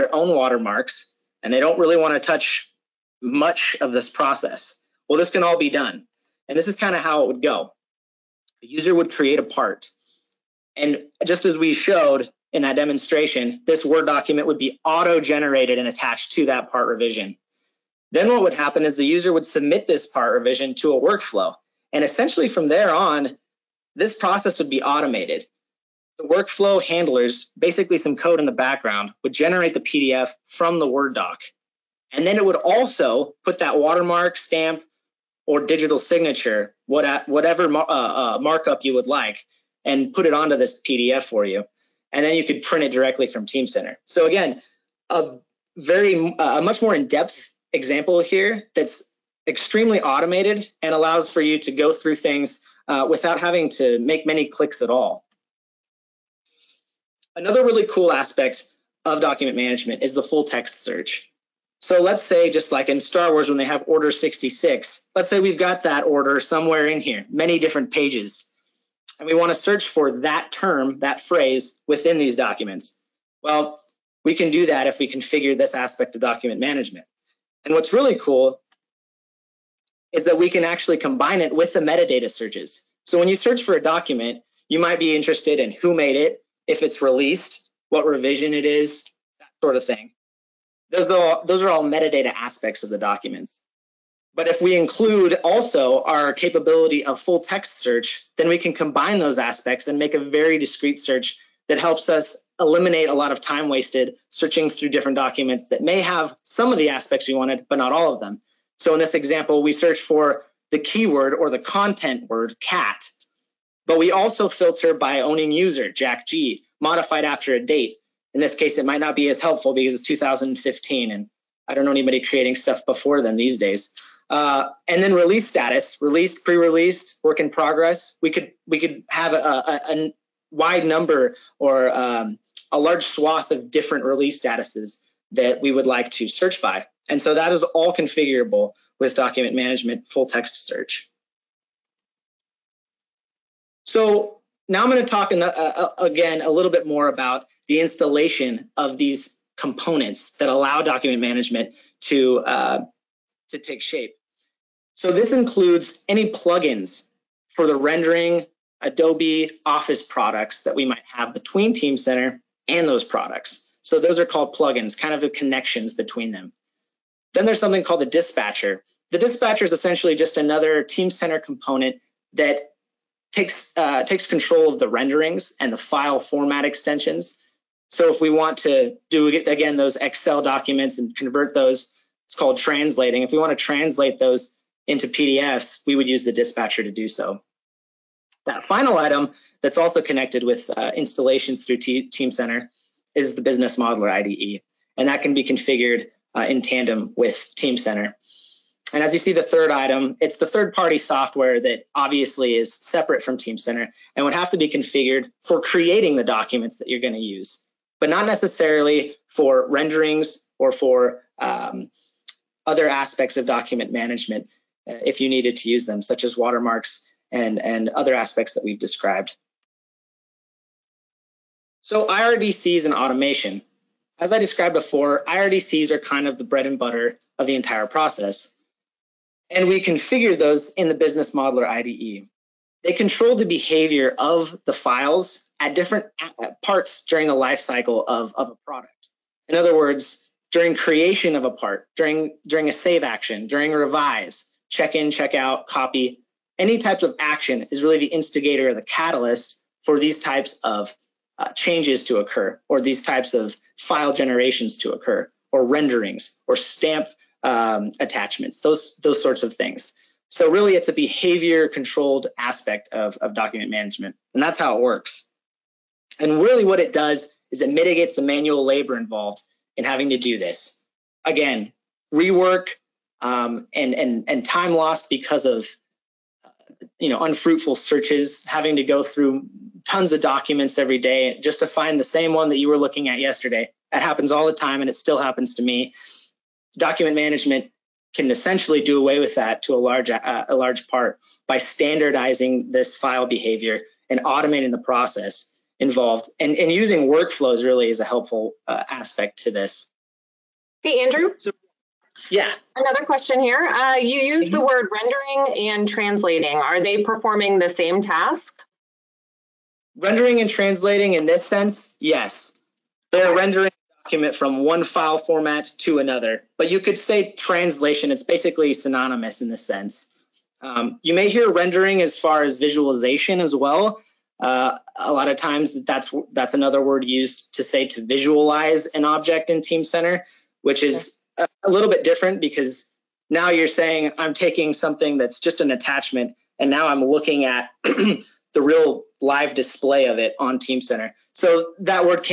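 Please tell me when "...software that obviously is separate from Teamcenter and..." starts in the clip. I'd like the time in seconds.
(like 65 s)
200 s.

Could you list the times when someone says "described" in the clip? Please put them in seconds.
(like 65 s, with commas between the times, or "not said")
218 s, 224 s.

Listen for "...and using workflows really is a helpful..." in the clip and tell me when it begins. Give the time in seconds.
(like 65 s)
296 s.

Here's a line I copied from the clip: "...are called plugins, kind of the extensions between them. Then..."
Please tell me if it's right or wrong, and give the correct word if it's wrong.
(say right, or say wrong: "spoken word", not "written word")
wrong: "connections", not "extensions".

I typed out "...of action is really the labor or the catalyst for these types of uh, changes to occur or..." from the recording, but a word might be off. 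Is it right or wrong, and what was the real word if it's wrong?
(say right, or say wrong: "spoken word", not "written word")
wrong: "instigator", not "labor".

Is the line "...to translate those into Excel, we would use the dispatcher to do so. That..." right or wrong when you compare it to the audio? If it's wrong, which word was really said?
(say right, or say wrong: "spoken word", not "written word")
wrong: "PDFs", not "Excel".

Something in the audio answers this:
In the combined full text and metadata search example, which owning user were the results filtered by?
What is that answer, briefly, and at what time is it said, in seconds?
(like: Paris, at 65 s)
Jack G, at 115 s.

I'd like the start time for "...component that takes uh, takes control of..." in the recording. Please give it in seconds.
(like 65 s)
171 s.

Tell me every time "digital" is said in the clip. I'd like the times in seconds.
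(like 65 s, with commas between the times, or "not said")
35 s.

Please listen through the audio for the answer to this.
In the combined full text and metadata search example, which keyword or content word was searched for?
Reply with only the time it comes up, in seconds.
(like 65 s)
112 s.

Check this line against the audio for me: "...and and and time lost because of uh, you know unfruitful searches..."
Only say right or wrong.
right.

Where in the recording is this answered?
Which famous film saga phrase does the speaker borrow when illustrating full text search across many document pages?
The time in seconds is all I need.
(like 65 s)
63 s.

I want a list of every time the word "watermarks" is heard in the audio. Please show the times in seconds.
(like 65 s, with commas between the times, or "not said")
0 s, 33 s, 216 s.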